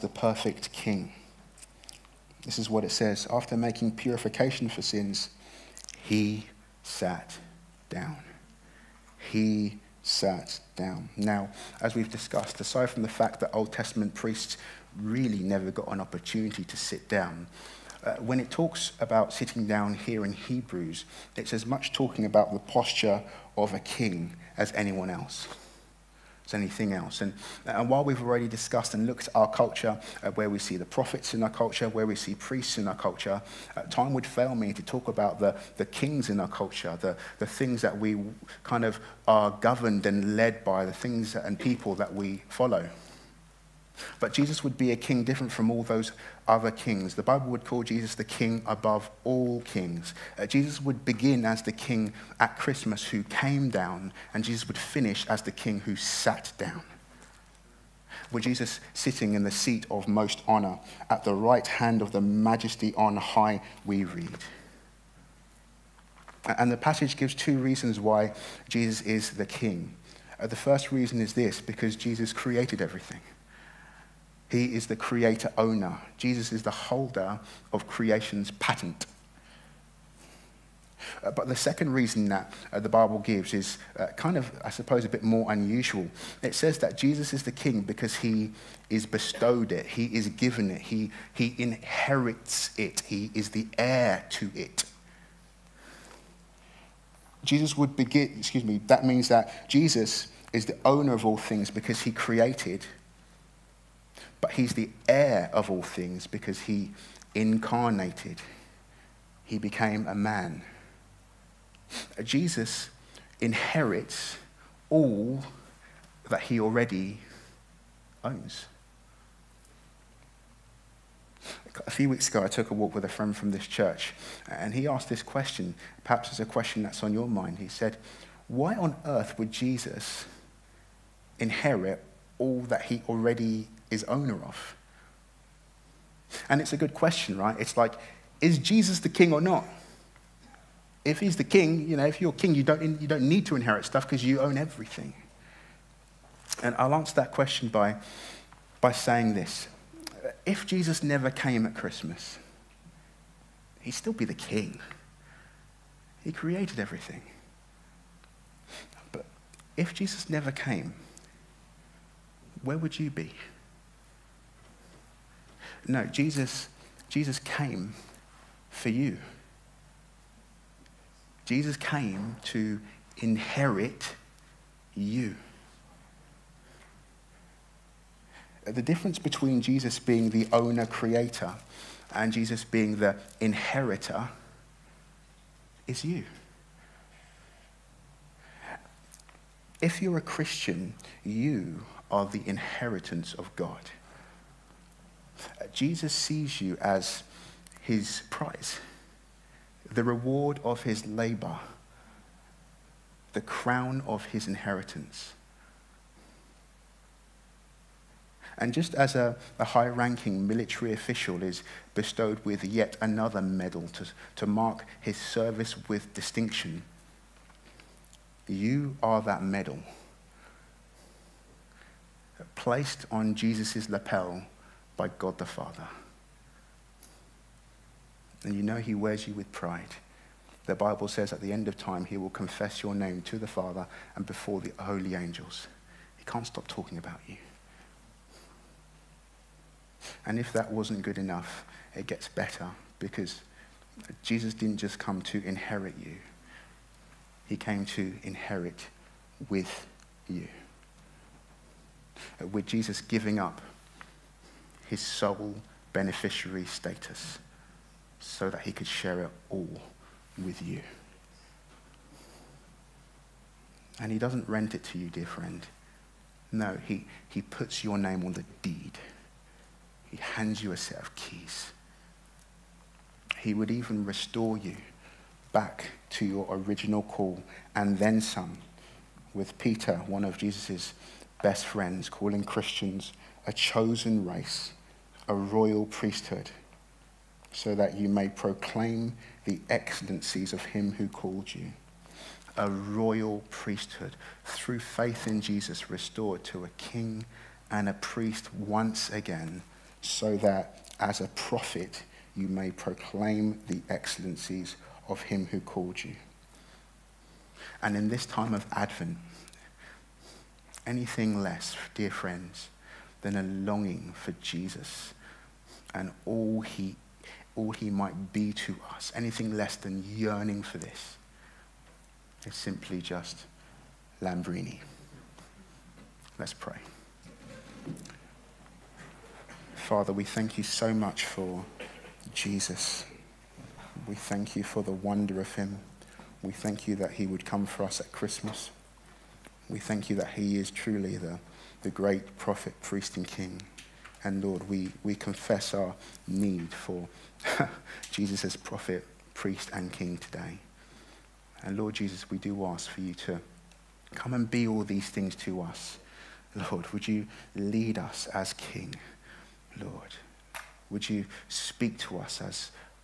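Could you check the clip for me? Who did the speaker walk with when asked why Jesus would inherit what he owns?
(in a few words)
A friend from this church.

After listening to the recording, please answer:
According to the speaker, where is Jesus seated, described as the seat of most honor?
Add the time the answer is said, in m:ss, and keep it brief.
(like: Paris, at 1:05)
At the right hand of the majesty on high, at 1:01.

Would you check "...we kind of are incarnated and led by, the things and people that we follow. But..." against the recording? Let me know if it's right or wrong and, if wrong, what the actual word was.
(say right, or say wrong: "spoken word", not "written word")
wrong: "governed", not "incarnated".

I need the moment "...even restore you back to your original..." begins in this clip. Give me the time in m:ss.
4:33.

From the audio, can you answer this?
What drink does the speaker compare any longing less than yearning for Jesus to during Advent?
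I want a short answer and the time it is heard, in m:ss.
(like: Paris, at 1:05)
Lambrini, at 5:24.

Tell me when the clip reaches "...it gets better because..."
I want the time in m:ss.
4:01.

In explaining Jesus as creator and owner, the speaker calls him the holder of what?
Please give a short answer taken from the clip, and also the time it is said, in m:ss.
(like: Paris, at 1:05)
Creation's patent, at 1:17.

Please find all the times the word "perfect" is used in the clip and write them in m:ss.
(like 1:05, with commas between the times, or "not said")
0:00.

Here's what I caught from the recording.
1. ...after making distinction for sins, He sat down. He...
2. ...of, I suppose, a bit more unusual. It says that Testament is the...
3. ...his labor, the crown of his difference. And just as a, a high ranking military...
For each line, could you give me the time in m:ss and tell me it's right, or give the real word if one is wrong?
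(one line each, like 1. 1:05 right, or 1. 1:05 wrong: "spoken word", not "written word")
1. 0:03 wrong: "purification", not "distinction"
2. 1:24 wrong: "Jesus", not "Testament"
3. 3:20 wrong: "inheritance", not "difference".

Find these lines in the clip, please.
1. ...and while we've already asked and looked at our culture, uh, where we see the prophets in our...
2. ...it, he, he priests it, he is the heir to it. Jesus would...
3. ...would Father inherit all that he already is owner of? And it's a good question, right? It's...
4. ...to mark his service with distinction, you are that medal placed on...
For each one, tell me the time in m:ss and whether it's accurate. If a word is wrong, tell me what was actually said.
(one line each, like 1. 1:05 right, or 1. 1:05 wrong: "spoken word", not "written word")
1. 0:27 wrong: "discussed", not "asked"
2. 1:30 wrong: "inherits", not "priests"
3. 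2:09 wrong: "Jesus", not "Father"
4. 3:34 right.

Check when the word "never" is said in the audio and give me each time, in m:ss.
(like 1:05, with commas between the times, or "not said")
0:15, 2:31, 2:40.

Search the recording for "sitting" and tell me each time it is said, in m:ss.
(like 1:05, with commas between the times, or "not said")
0:19, 0:58.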